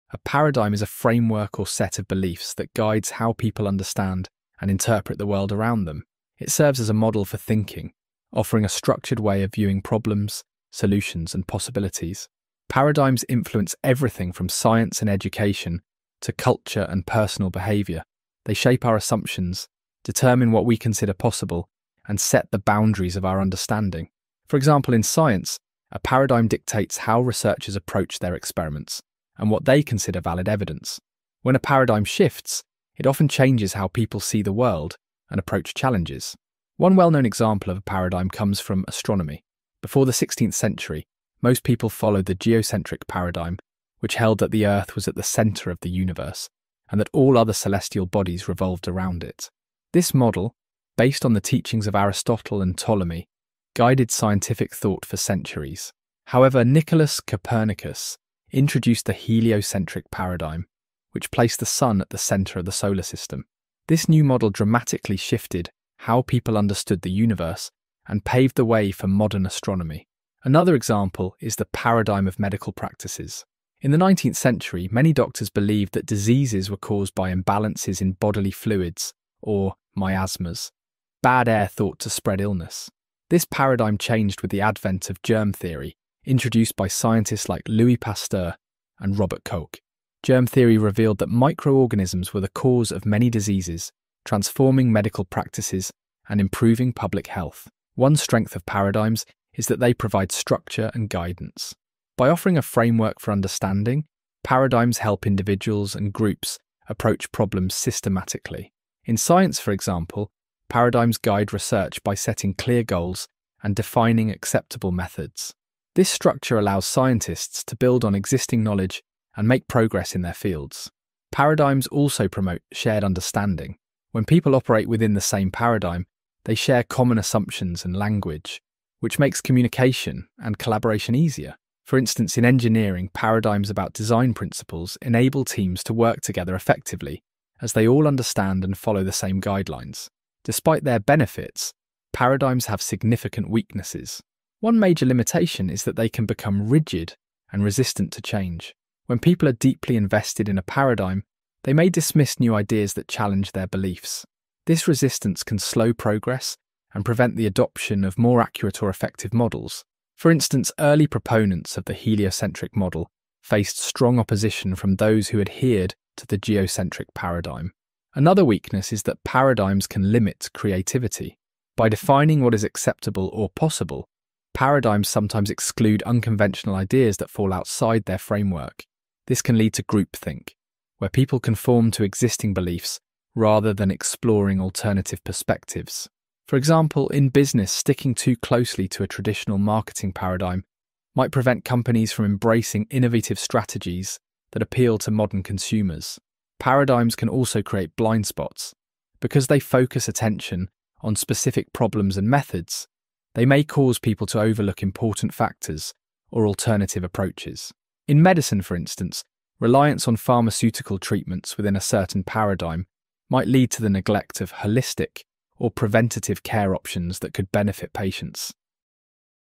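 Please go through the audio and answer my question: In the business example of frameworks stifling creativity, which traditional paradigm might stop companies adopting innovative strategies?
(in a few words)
marketing paradigm.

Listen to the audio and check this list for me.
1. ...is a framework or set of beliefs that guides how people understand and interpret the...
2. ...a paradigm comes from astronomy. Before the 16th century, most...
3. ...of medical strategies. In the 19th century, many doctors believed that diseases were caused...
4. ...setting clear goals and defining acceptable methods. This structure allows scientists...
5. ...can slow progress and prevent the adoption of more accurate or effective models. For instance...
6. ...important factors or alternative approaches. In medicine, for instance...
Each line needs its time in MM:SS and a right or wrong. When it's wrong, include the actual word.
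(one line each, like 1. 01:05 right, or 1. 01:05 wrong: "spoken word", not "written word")
1. 00:00 right
2. 00:37 right
3. 01:12 wrong: "practices", not "strategies"
4. 01:52 right
5. 02:35 right
6. 03:24 right.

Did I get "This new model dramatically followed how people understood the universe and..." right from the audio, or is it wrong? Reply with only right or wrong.
wrong.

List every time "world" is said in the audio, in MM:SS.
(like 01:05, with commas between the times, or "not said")
00:05, 00:34.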